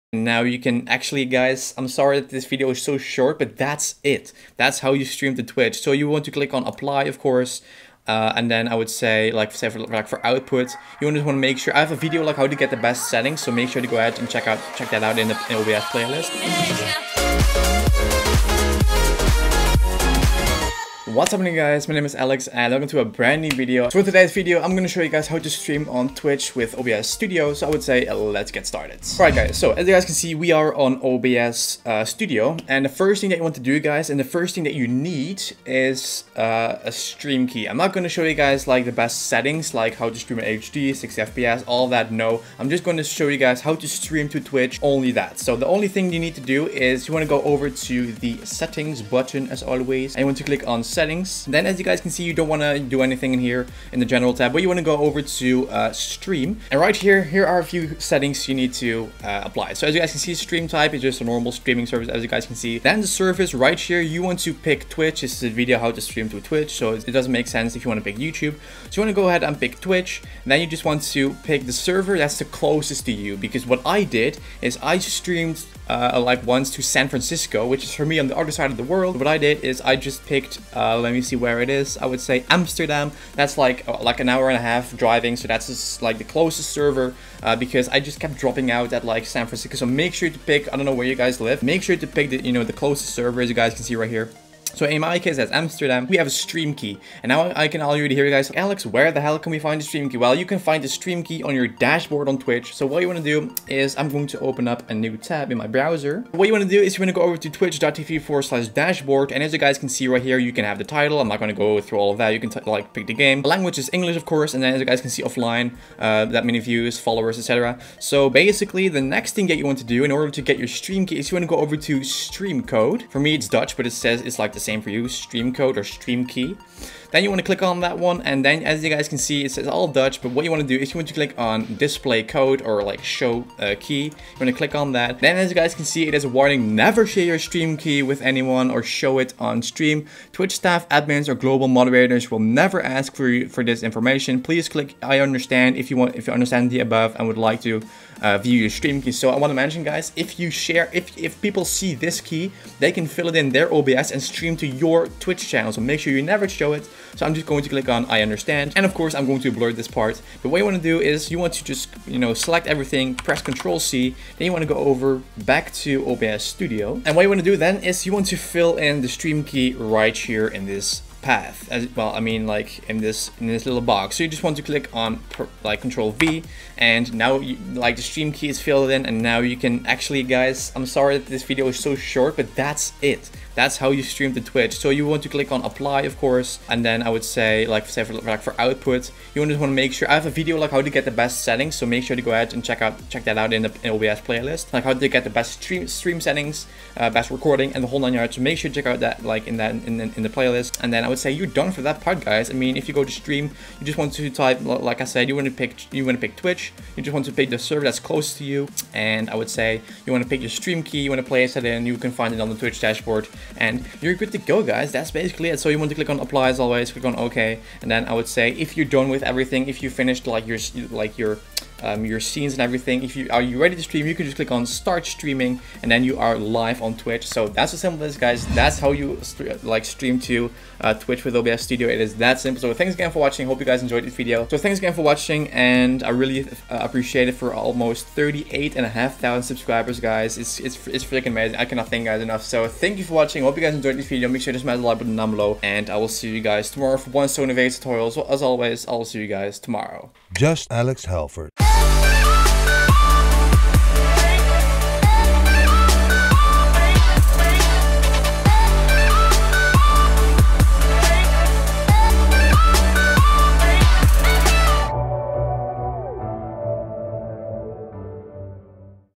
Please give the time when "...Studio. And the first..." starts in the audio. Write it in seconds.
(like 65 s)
32 s.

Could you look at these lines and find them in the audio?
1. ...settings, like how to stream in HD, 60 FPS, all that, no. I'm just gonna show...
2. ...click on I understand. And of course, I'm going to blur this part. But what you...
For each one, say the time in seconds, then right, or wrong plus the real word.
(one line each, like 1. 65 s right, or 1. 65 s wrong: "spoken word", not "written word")
1. 39 s right
2. 157 s right.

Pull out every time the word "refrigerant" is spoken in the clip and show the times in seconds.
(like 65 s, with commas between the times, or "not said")
not said.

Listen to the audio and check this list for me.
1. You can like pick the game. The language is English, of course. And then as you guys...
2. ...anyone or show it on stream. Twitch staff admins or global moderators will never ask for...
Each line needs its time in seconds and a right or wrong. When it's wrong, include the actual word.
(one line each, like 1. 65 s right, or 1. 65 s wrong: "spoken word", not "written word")
1. 112 s right
2. 138 s right.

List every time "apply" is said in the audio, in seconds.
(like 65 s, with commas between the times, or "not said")
6 s, 59 s, 185 s, 216 s.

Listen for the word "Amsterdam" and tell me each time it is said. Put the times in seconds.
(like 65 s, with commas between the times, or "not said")
82 s, 95 s.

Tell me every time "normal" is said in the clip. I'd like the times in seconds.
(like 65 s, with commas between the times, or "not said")
61 s.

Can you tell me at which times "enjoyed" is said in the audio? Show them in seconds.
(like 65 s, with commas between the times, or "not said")
233 s, 243 s.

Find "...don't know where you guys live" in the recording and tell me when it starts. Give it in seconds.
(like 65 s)
90 s.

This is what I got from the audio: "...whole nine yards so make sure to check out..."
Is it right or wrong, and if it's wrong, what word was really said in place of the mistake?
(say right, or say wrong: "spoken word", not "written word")
right.